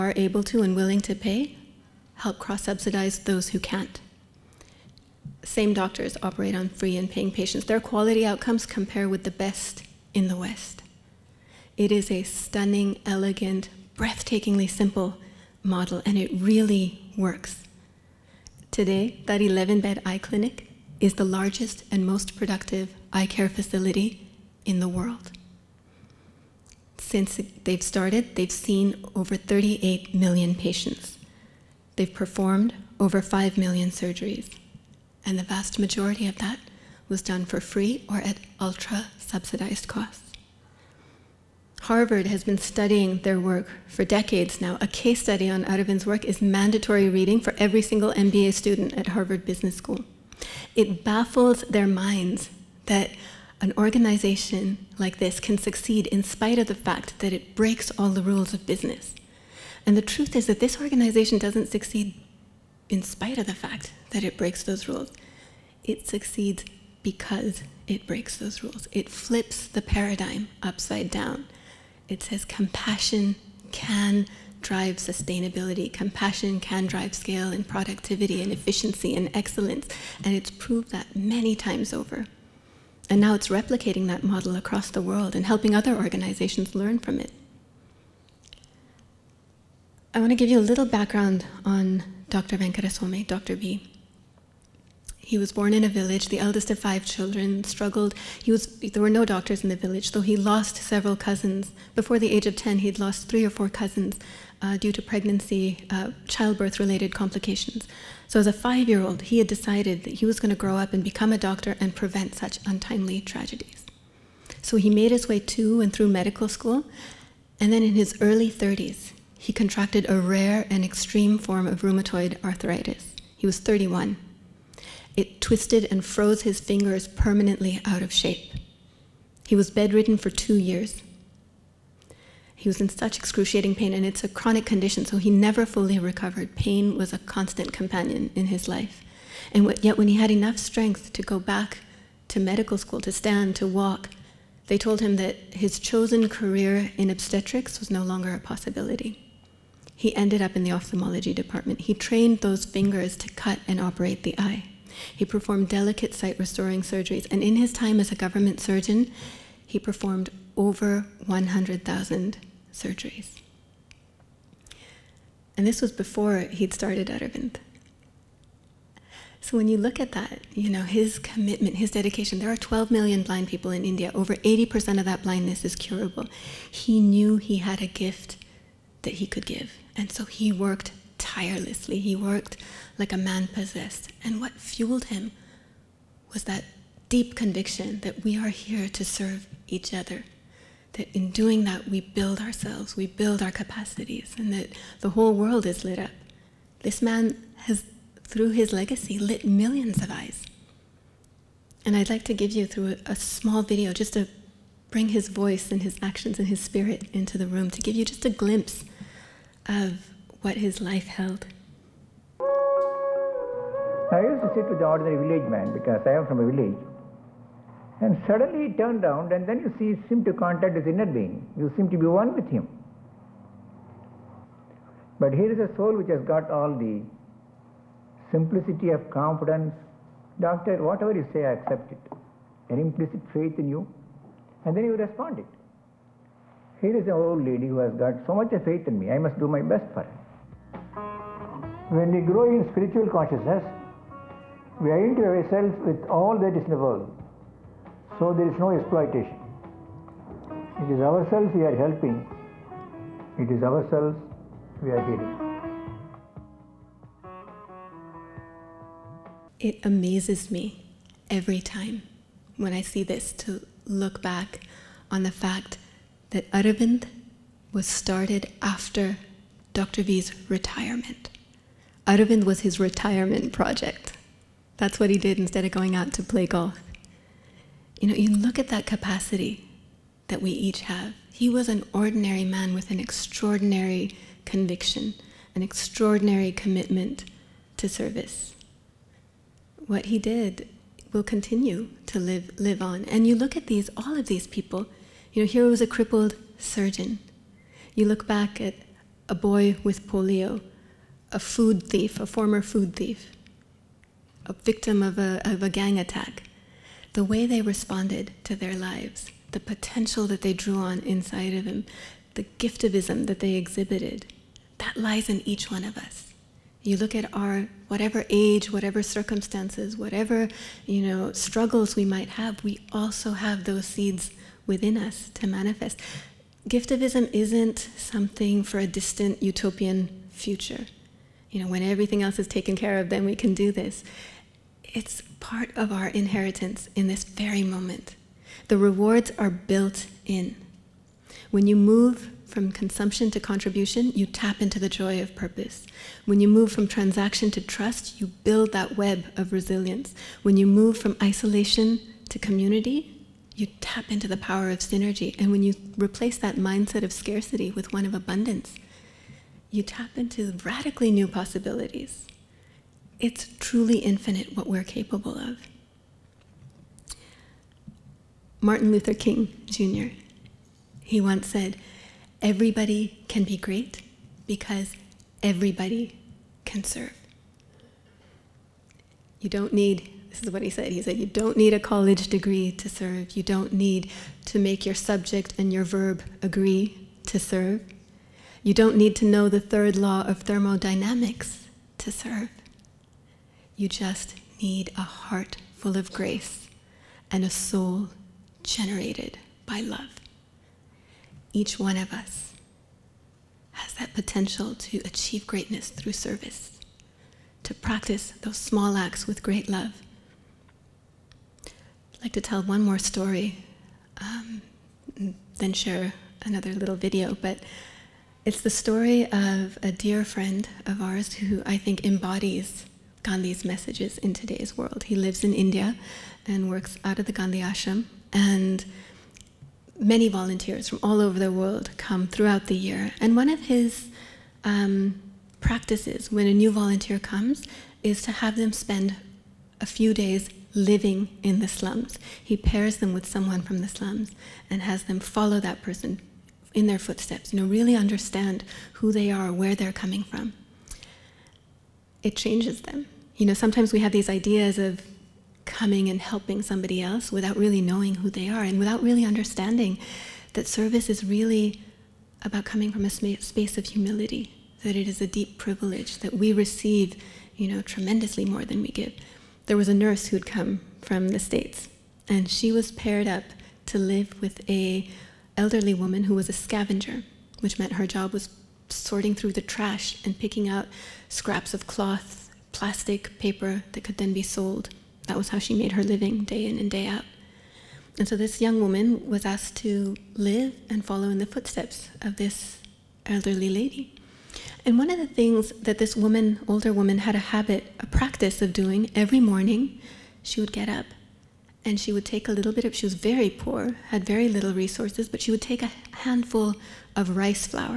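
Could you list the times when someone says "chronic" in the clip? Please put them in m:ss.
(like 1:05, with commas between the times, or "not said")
2:14.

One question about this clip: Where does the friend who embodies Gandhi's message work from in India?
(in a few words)
Gandhi Ashram.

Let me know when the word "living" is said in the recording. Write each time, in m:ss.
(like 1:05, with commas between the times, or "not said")
7:20, 8:06.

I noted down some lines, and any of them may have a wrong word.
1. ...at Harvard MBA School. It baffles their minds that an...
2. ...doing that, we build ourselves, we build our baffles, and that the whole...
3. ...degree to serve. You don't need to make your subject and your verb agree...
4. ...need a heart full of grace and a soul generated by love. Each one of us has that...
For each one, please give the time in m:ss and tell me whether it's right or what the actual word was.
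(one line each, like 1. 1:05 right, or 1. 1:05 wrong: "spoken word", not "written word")
1. 0:48 wrong: "Business", not "MBA"
2. 3:11 wrong: "capacities", not "baffles"
3. 6:22 right
4. 6:34 right.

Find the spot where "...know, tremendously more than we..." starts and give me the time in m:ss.
7:47.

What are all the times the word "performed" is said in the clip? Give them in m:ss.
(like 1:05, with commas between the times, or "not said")
0:32, 2:35, 2:39.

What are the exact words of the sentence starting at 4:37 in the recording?
You know, you look at that capacity that we each have.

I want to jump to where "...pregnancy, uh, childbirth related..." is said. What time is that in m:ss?
1:45.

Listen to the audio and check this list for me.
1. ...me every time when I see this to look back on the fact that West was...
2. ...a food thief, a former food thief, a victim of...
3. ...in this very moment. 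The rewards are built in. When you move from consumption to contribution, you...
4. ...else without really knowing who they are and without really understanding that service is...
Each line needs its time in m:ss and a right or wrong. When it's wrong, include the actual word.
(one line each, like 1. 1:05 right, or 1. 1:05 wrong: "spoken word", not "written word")
1. 4:20 wrong: "Aravind", not "West"
2. 5:01 right
3. 5:36 right
4. 7:37 right.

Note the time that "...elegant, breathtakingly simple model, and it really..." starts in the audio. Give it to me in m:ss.
0:13.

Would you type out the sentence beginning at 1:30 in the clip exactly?
I want to give you a little background on Dr.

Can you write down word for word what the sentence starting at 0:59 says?
And the truth is that this organization doesn't succeed in spite of the fact that it breaks those rules.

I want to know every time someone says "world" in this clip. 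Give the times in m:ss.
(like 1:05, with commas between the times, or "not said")
0:24, 1:25, 3:15, 4:06, 7:04, 7:11.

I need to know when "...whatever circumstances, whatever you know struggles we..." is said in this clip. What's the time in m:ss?
5:18.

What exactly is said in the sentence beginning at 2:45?
And this was before he'd started Aravind.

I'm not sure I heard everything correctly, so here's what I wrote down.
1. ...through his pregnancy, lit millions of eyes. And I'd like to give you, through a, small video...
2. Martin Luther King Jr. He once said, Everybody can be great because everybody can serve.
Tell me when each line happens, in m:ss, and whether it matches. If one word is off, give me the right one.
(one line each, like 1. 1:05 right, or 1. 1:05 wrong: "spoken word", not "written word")
1. 3:18 wrong: "legacy", not "pregnancy"
2. 6:08 right.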